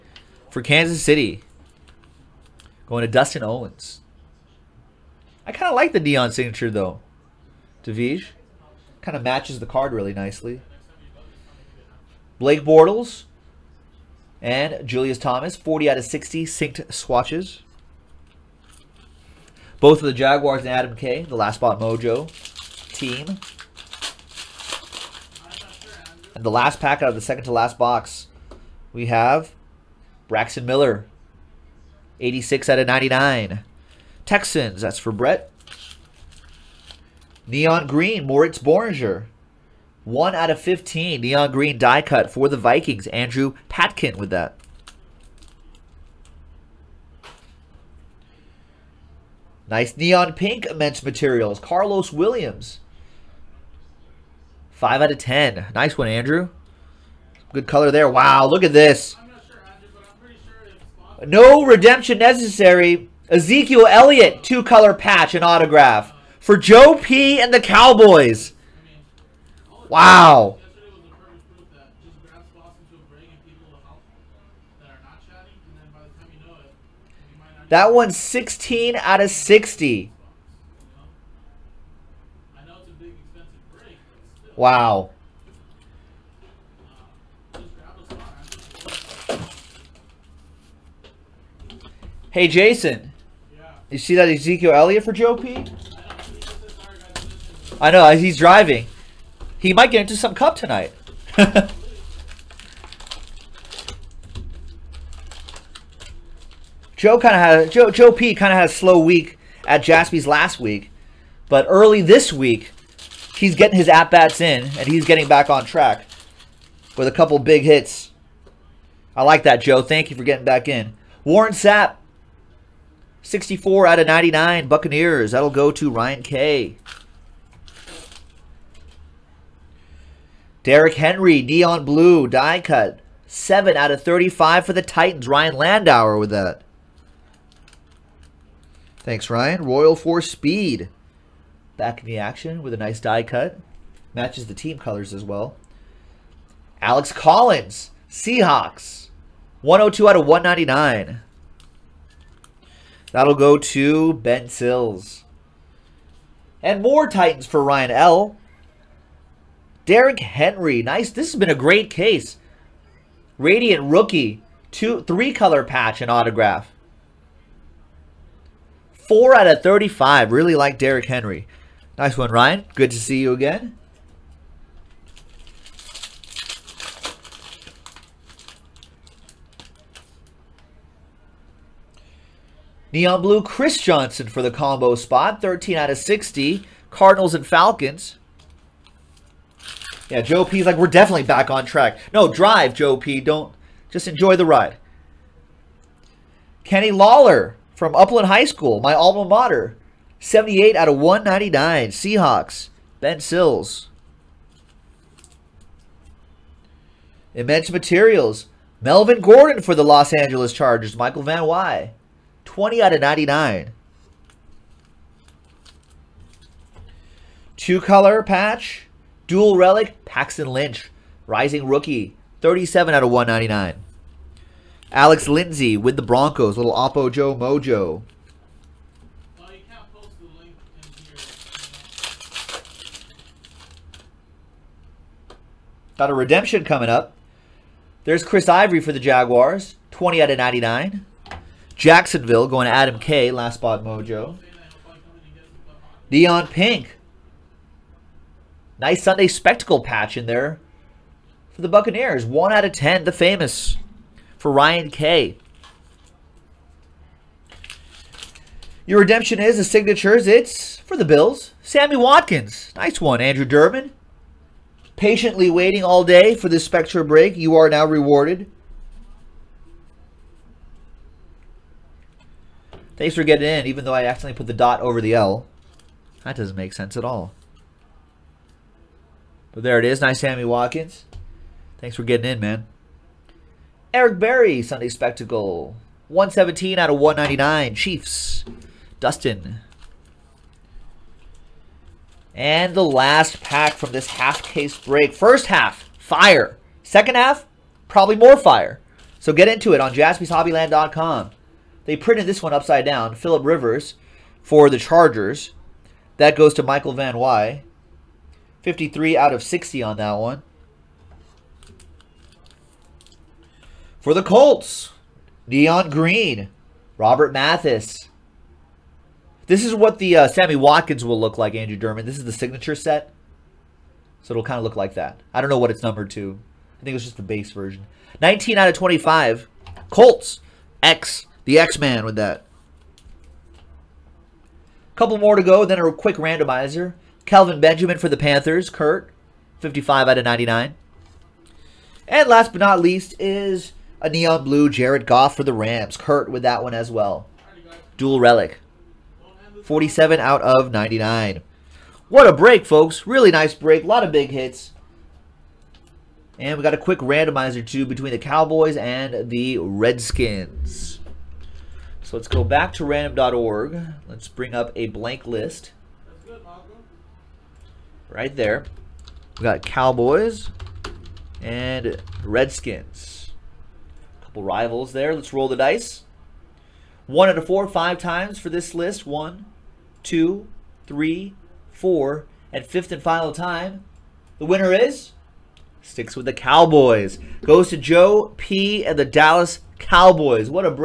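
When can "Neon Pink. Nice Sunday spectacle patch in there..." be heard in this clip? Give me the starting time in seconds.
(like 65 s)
246 s.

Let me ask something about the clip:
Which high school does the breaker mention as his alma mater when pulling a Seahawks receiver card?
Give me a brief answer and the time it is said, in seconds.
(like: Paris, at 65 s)
Upland High School, at 197 s.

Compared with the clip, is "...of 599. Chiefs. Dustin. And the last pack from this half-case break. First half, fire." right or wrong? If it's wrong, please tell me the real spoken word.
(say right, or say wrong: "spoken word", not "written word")
wrong: "199", not "599".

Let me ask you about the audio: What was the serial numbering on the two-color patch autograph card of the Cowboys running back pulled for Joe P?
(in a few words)
16 out of 60.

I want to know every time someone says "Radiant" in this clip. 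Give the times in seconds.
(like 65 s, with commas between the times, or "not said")
163 s.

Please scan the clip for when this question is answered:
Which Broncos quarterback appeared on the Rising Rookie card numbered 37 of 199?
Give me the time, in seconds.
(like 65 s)
220 s.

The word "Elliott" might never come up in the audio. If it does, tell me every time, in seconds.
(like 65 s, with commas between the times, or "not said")
63 s, 94 s.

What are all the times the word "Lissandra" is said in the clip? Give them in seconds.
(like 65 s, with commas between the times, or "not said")
not said.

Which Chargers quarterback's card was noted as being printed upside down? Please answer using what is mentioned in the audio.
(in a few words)
Philip Rivers.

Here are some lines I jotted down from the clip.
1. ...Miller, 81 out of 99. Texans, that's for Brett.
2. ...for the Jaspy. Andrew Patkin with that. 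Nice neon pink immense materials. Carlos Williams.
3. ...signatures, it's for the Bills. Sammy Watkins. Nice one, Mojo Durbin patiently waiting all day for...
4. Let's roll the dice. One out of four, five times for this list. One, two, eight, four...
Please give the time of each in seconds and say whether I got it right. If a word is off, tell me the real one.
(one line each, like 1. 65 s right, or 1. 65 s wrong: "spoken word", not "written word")
1. 30 s wrong: "86", not "81"
2. 42 s wrong: "Vikings", not "Jaspy"
3. 259 s wrong: "Andrew", not "Mojo"
4. 375 s wrong: "three", not "eight".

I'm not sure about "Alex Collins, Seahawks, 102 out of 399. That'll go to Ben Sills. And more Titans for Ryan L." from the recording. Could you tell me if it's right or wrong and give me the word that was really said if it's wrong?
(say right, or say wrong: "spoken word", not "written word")
wrong: "199", not "399".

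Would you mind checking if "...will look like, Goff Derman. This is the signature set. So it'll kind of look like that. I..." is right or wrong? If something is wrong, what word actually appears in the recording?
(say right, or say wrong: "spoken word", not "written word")
wrong: "Andrew", not "Goff".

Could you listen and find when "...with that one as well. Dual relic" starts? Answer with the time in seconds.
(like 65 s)
346 s.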